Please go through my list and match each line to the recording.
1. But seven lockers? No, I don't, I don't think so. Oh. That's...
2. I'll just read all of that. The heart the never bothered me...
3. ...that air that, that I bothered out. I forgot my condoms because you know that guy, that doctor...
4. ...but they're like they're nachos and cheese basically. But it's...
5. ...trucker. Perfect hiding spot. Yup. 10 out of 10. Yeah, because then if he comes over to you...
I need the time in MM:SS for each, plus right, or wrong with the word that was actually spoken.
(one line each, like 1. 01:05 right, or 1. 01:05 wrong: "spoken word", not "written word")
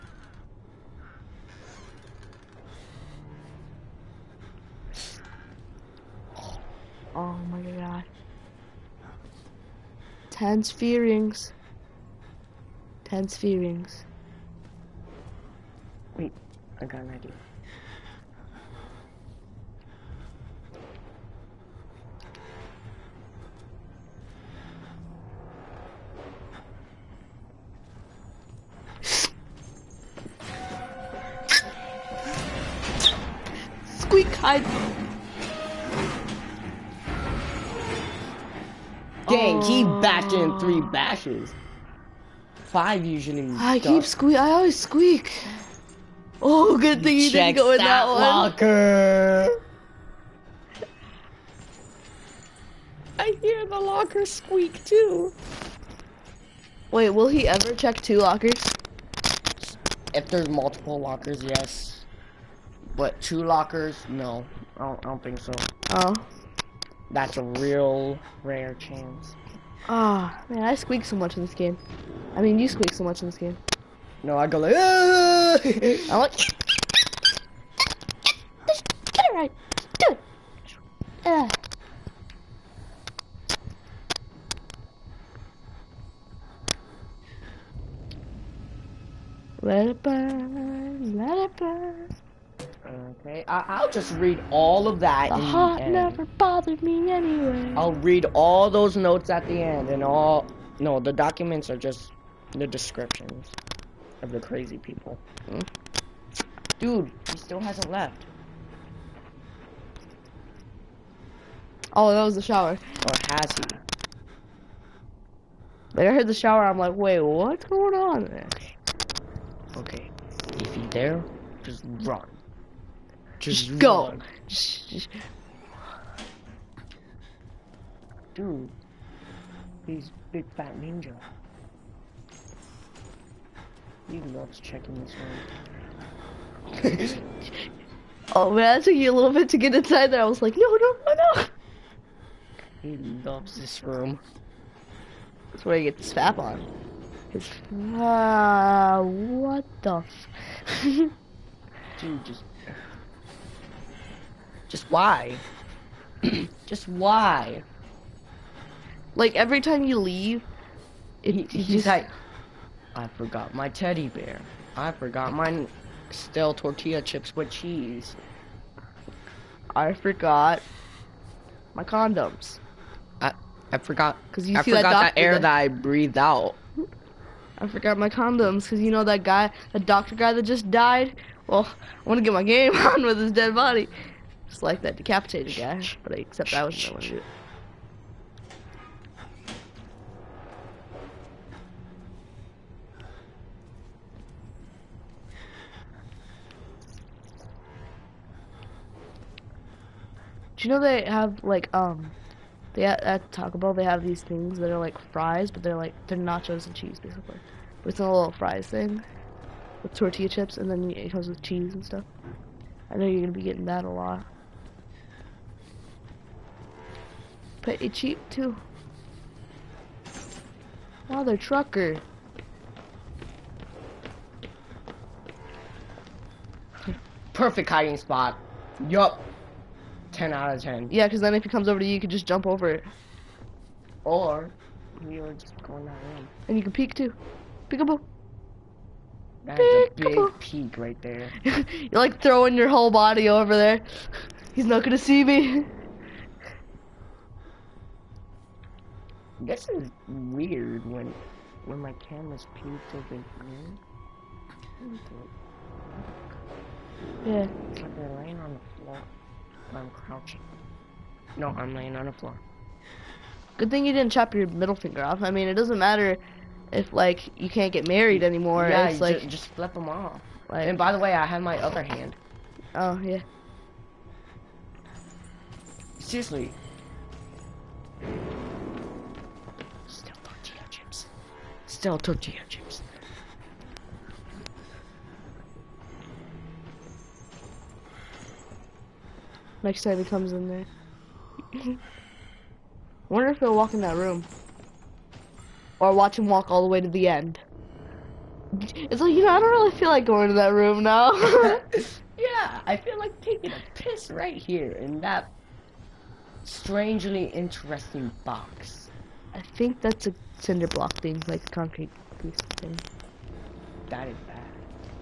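1. 01:02 wrong: "two", not "seven"
2. 01:33 right
3. 02:55 wrong: "breathed", not "bothered"
4. 03:25 right
5. 03:41 right.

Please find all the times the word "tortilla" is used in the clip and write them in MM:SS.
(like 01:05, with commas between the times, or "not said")
02:46, 03:29, 04:41.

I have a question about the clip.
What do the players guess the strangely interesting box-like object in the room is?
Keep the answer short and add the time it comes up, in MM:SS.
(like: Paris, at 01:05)
Cinder block, at 05:10.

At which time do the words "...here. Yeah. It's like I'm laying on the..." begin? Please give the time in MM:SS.
04:13.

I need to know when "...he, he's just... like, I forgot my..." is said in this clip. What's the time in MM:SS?
02:41.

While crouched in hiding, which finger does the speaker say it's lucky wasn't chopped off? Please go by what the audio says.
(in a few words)
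Middle finger.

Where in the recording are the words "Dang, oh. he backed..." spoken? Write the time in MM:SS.
00:39.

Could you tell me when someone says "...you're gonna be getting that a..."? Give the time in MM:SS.
03:33.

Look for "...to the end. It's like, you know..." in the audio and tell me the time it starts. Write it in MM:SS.
04:56.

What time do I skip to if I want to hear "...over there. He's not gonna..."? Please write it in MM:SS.
04:03.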